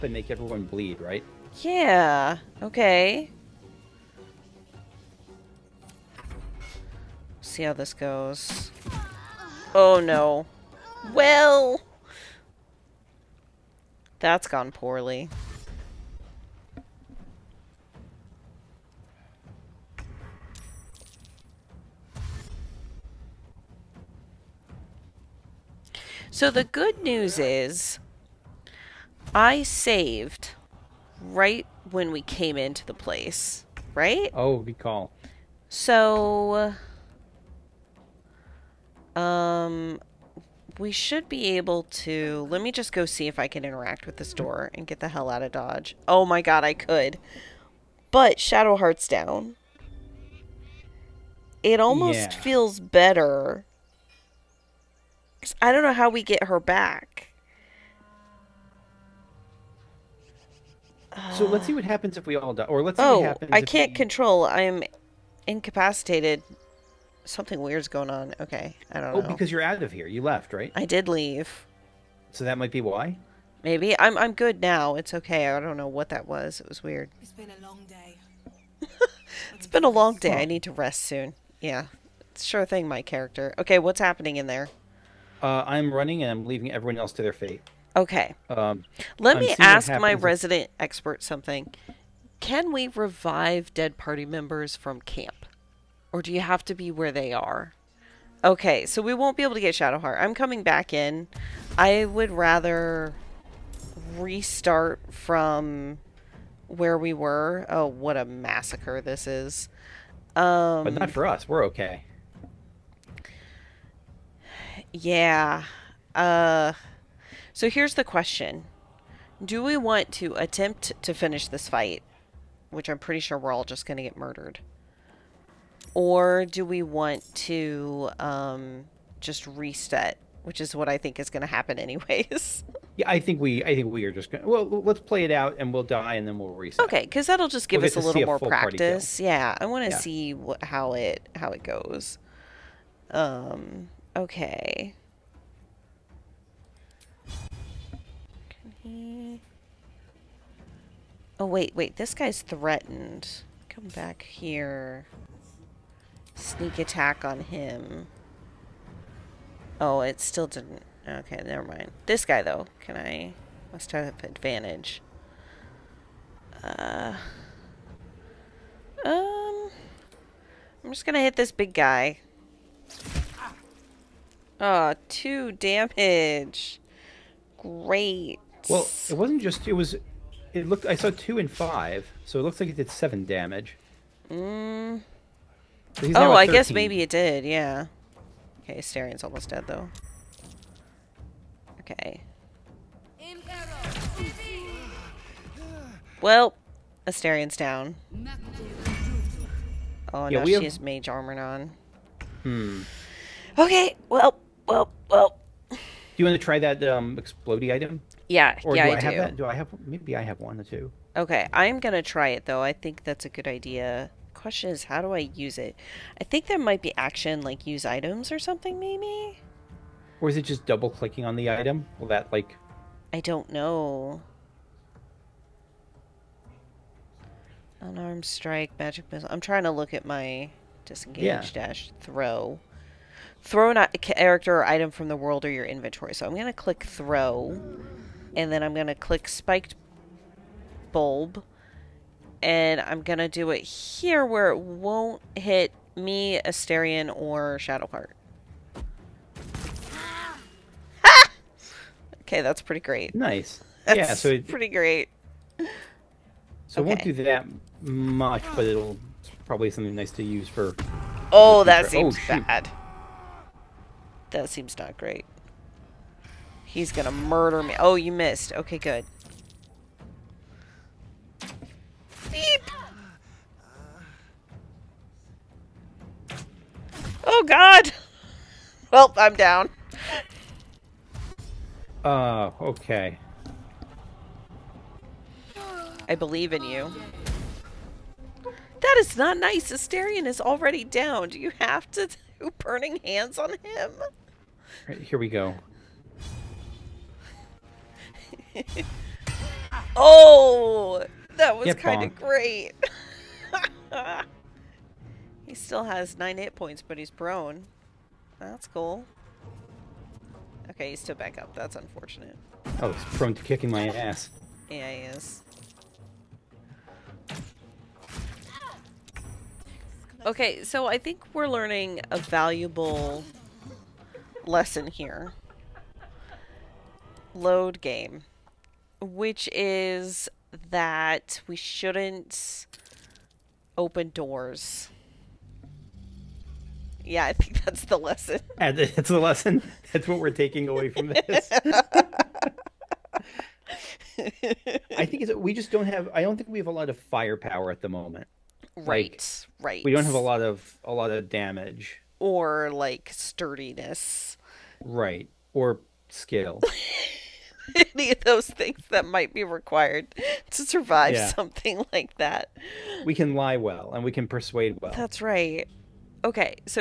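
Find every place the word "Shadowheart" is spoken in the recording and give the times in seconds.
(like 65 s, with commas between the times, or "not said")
48 s, 99 s, 247 s.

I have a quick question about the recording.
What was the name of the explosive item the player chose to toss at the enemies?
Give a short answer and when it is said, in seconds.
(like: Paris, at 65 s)
Spiked bulb, at 239 s.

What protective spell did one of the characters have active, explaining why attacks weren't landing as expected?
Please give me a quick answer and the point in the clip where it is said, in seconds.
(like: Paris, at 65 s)
Mage armor, at 200 s.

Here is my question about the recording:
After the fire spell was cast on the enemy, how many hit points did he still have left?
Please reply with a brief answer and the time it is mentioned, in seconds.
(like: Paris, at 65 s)
9, at 306 s.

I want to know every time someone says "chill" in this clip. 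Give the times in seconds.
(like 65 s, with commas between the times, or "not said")
not said.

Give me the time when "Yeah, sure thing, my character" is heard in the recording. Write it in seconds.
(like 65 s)
81 s.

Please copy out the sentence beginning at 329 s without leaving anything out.
Which is that we shouldn't open doors yeah, I think that's the lesson.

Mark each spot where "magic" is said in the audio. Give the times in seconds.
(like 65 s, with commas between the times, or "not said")
228 s.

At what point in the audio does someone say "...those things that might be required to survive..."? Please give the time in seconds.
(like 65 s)
358 s.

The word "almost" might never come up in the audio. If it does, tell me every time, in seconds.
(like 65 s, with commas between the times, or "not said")
51 s, 189 s.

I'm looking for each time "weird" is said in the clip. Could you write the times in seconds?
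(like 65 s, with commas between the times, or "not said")
67 s, 76 s.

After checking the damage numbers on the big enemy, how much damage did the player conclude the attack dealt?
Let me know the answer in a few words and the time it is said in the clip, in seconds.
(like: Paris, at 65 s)
7, at 182 s.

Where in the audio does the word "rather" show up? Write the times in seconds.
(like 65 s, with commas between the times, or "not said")
102 s.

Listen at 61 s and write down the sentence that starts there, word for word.
So let's see what happens if we all die.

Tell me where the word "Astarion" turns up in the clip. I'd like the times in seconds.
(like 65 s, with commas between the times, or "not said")
197 s, 246 s, 289 s.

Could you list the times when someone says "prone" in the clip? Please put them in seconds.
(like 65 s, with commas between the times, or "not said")
307 s, 313 s.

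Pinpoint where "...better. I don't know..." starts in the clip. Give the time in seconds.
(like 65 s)
52 s.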